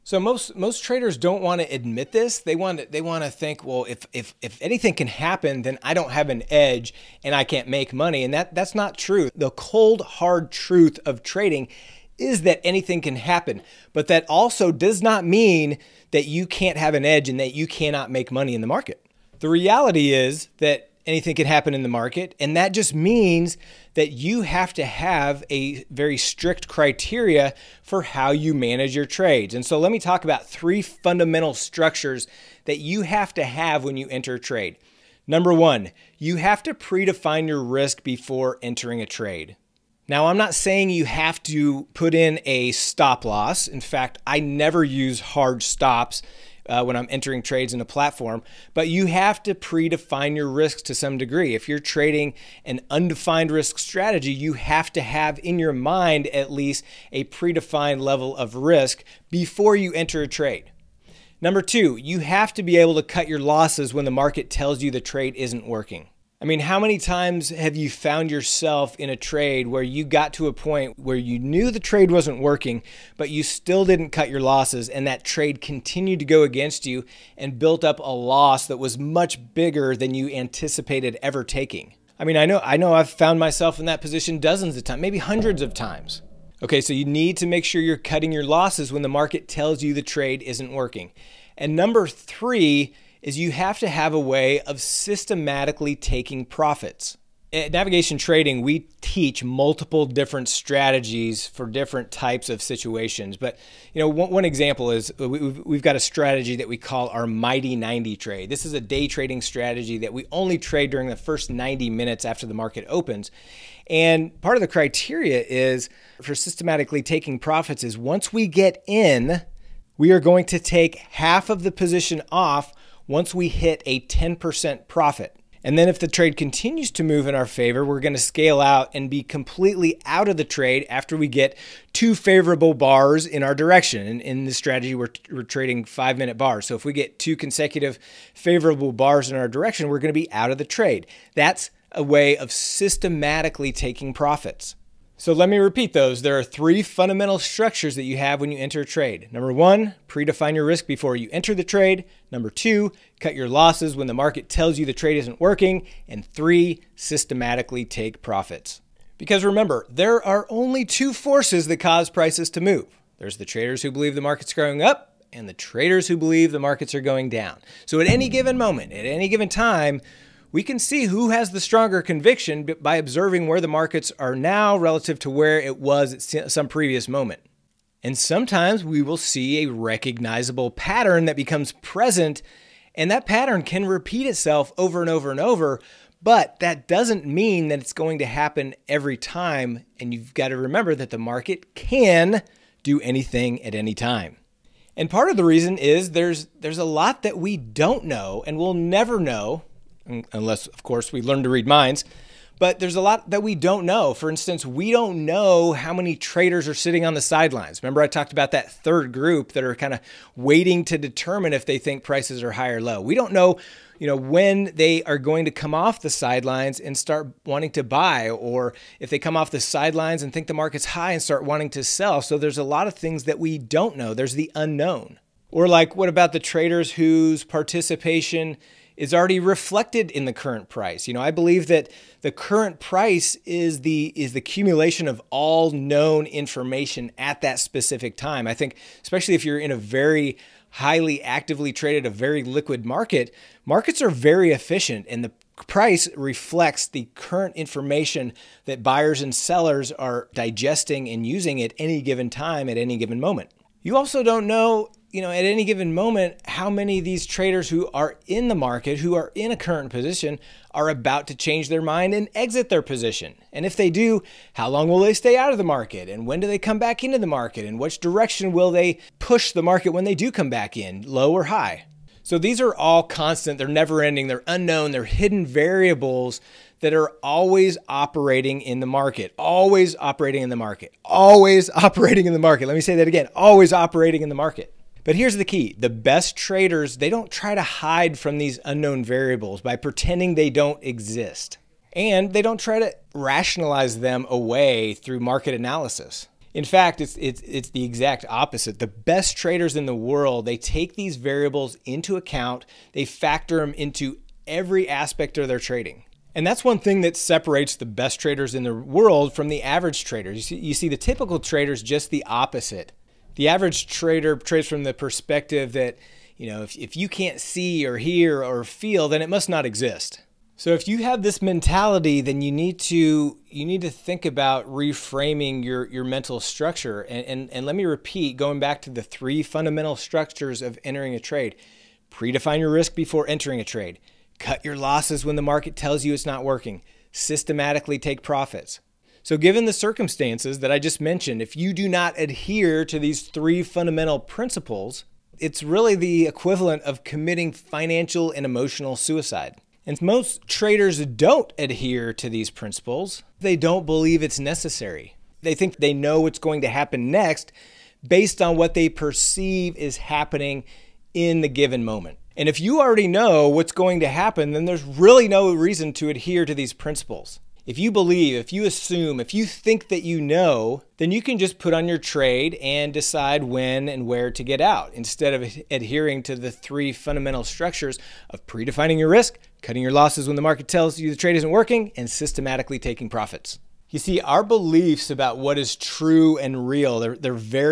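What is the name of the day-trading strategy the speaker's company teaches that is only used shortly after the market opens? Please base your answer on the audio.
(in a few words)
Mighty 90.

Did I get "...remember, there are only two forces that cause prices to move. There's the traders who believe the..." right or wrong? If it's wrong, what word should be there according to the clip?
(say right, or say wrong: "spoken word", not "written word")
right.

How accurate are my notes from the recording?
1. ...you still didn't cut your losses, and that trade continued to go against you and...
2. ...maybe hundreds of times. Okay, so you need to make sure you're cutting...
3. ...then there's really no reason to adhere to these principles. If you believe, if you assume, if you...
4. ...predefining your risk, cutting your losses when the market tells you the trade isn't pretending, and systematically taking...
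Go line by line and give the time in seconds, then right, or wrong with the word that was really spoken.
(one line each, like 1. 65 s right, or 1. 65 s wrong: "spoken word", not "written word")
1. 73 s right
2. 85 s right
3. 364 s right
4. 378 s wrong: "working", not "pretending".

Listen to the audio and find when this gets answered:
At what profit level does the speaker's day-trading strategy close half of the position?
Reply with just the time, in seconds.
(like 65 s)
123 s.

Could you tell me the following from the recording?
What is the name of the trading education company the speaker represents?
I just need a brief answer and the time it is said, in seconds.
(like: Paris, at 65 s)
Navigation Trading, at 97 s.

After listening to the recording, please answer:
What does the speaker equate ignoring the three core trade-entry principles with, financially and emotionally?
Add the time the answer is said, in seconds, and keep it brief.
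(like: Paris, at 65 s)
suicide, at 347 s.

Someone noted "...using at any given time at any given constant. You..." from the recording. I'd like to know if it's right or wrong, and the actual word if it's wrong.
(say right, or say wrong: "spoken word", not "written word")
wrong: "moment", not "constant".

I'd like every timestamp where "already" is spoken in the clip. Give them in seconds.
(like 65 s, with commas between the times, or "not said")
229 s, 362 s.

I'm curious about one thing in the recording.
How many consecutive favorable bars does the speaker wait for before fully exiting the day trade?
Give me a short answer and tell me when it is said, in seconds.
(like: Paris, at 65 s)
2, at 137 s.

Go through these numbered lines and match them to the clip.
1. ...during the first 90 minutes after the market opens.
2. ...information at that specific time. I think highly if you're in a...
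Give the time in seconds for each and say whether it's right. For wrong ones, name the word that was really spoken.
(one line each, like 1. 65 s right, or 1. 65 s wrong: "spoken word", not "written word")
1. 110 s right
2. 236 s wrong: "especially", not "highly".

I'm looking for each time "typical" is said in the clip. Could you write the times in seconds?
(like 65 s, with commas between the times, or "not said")
310 s.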